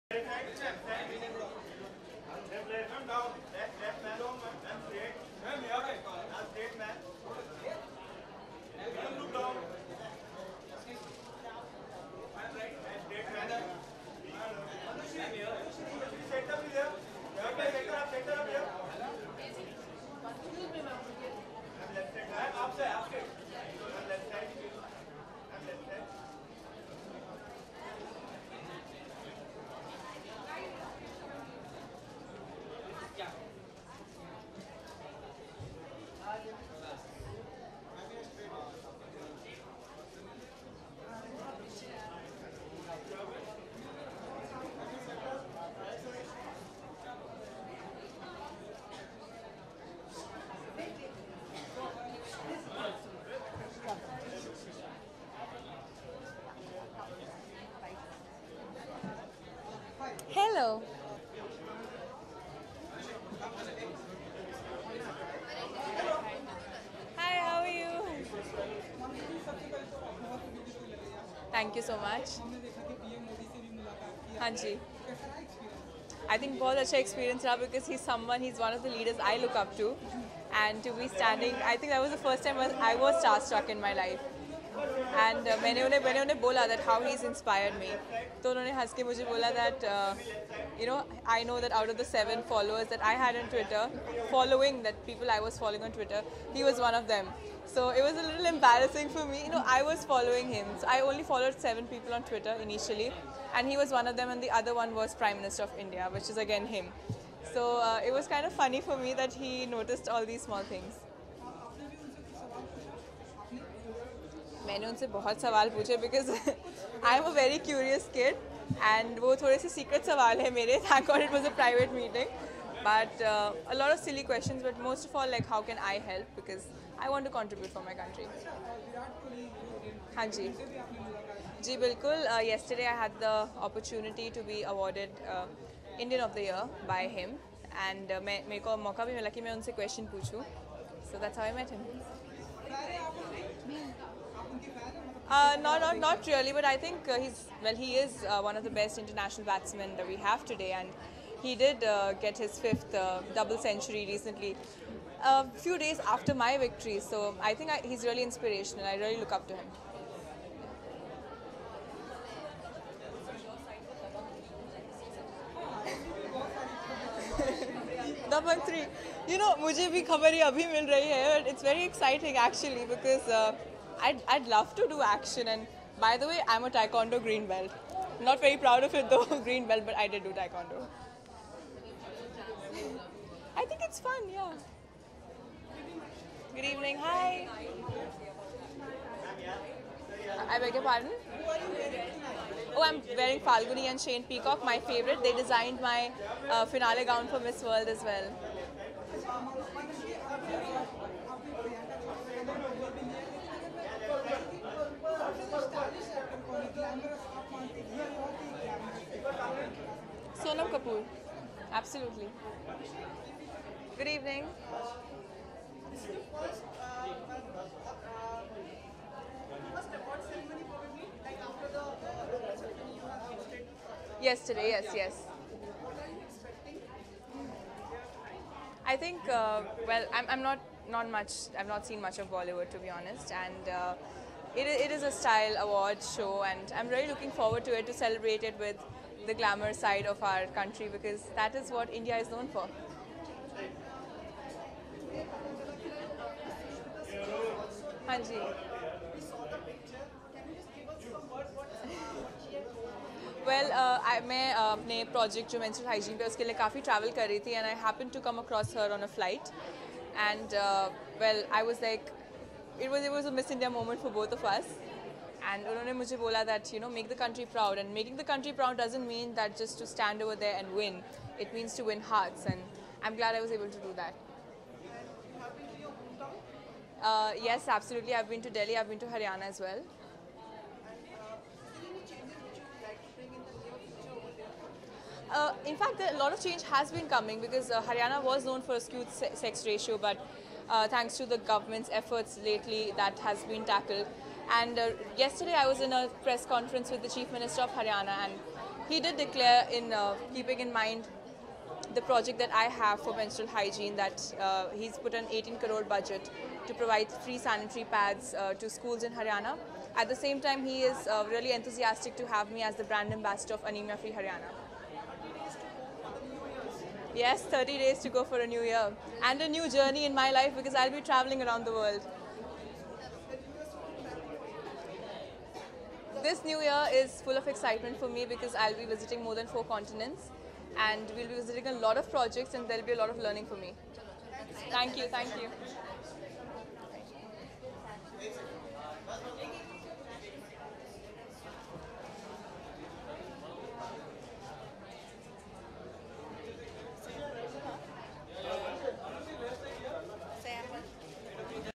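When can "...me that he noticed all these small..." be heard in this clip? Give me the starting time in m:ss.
1:49.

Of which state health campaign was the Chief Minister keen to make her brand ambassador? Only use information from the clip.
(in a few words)
Anemia Free Haryana.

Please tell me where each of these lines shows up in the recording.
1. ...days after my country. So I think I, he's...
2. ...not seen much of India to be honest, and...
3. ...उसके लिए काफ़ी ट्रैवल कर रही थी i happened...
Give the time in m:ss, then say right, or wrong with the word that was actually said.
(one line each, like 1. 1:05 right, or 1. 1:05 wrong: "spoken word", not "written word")
1. 2:35 wrong: "victory", not "country"
2. 3:51 wrong: "Bollywood", not "India"
3. 4:16 right.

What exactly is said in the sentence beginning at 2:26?
But I think uh, he's well.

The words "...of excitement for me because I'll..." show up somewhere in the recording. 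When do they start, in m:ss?
5:27.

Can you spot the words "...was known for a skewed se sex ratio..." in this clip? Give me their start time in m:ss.
4:48.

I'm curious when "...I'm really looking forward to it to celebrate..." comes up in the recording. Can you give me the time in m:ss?
3:56.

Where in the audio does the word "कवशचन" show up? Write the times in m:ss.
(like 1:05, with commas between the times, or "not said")
2:04, 2:19.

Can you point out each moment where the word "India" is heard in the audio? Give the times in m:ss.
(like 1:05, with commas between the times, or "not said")
1:45, 4:01, 4:23.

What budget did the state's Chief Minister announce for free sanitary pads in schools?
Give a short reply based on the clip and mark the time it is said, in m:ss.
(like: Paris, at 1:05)
18 crore, at 5:05.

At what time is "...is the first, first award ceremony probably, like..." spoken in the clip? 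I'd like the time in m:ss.
3:36.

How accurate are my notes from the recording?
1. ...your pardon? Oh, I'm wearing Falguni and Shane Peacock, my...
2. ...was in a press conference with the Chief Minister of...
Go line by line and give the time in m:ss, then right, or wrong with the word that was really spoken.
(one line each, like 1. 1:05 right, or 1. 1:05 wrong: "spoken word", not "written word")
1. 3:10 right
2. 4:55 right.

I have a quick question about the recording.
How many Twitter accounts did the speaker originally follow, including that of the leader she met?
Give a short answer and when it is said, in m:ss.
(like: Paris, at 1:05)
7, at 1:41.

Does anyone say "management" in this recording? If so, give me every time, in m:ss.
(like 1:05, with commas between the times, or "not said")
not said.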